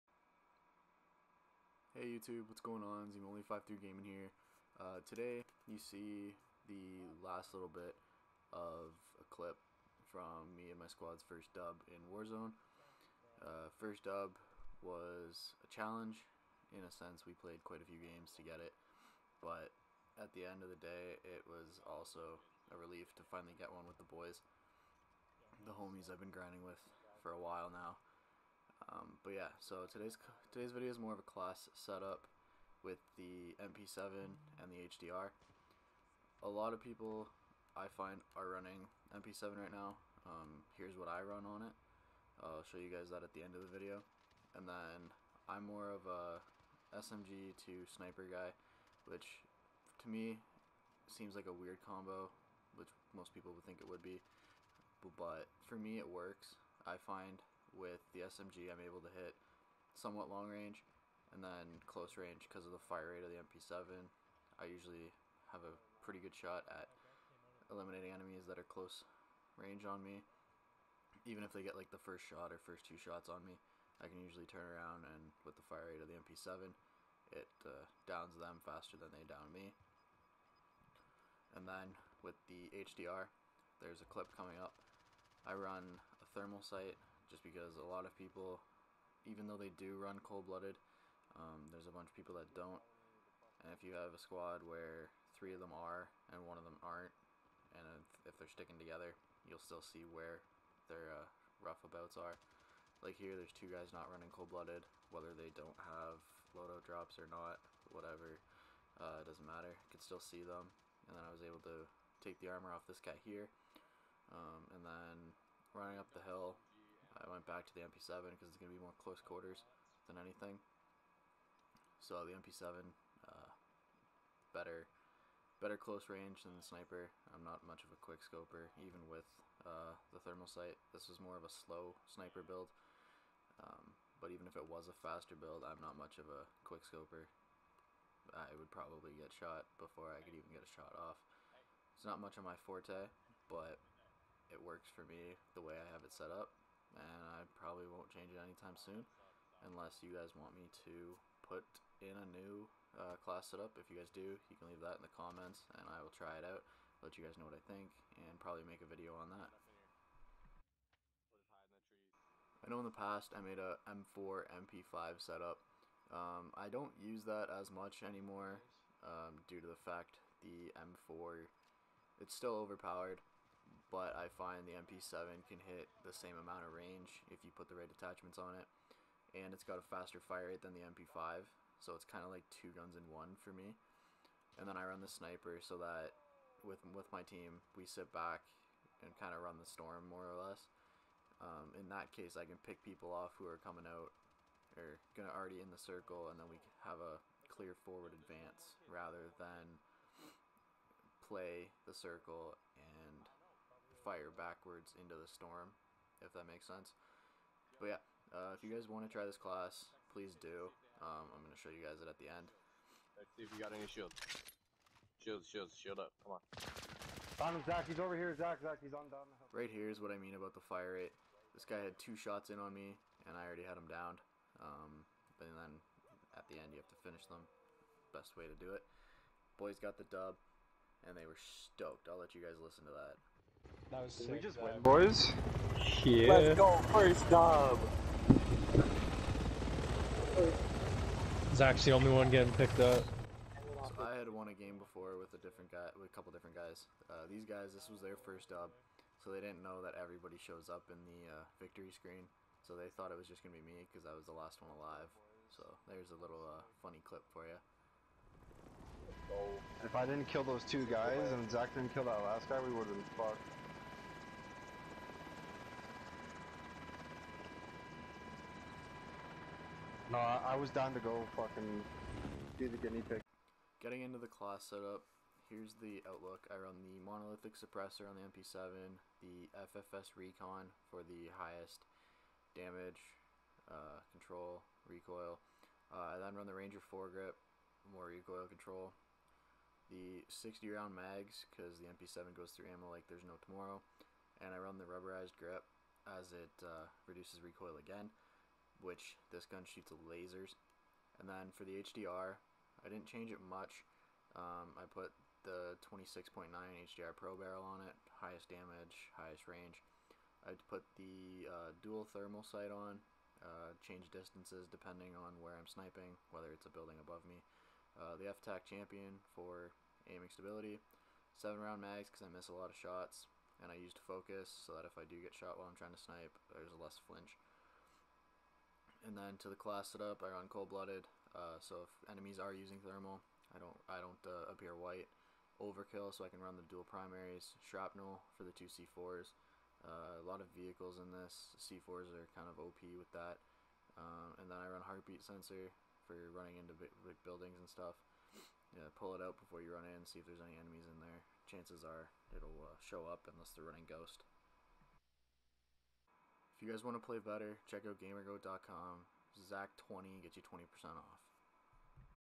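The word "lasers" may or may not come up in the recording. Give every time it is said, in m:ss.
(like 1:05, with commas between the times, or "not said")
5:00.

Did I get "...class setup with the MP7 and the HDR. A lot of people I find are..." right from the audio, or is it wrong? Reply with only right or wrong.
right.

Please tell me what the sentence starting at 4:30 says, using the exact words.
No, I, was down to go fucking do the guinea pig.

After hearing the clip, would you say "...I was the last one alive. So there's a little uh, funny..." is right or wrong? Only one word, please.
right.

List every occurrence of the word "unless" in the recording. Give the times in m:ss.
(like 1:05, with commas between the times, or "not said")
2:29, 5:53.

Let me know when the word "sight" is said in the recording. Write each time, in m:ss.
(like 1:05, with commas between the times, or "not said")
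1:26, 2:10, 5:12.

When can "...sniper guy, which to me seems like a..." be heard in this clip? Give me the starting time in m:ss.
0:47.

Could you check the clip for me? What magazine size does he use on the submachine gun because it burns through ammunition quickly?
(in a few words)
60 round.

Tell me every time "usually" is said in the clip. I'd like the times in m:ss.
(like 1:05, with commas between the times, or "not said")
1:04, 1:14.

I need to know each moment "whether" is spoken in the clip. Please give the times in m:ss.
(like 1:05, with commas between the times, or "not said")
1:45, 5:16.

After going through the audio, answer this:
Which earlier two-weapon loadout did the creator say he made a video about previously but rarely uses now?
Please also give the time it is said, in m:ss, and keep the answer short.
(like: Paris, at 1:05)
M4 MP5, at 2:43.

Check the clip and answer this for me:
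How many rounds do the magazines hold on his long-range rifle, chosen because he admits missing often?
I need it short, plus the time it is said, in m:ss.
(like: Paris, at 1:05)
7, at 5:21.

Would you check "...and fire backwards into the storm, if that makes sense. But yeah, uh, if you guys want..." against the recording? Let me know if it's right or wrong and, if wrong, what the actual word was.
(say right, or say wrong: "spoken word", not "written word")
right.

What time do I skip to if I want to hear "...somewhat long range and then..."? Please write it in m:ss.
0:59.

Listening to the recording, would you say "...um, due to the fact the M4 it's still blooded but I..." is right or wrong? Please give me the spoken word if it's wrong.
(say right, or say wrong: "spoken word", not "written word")
wrong: "overpowered", not "blooded".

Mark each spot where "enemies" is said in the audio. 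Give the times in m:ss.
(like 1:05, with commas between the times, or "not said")
1:08, 5:32, 5:50.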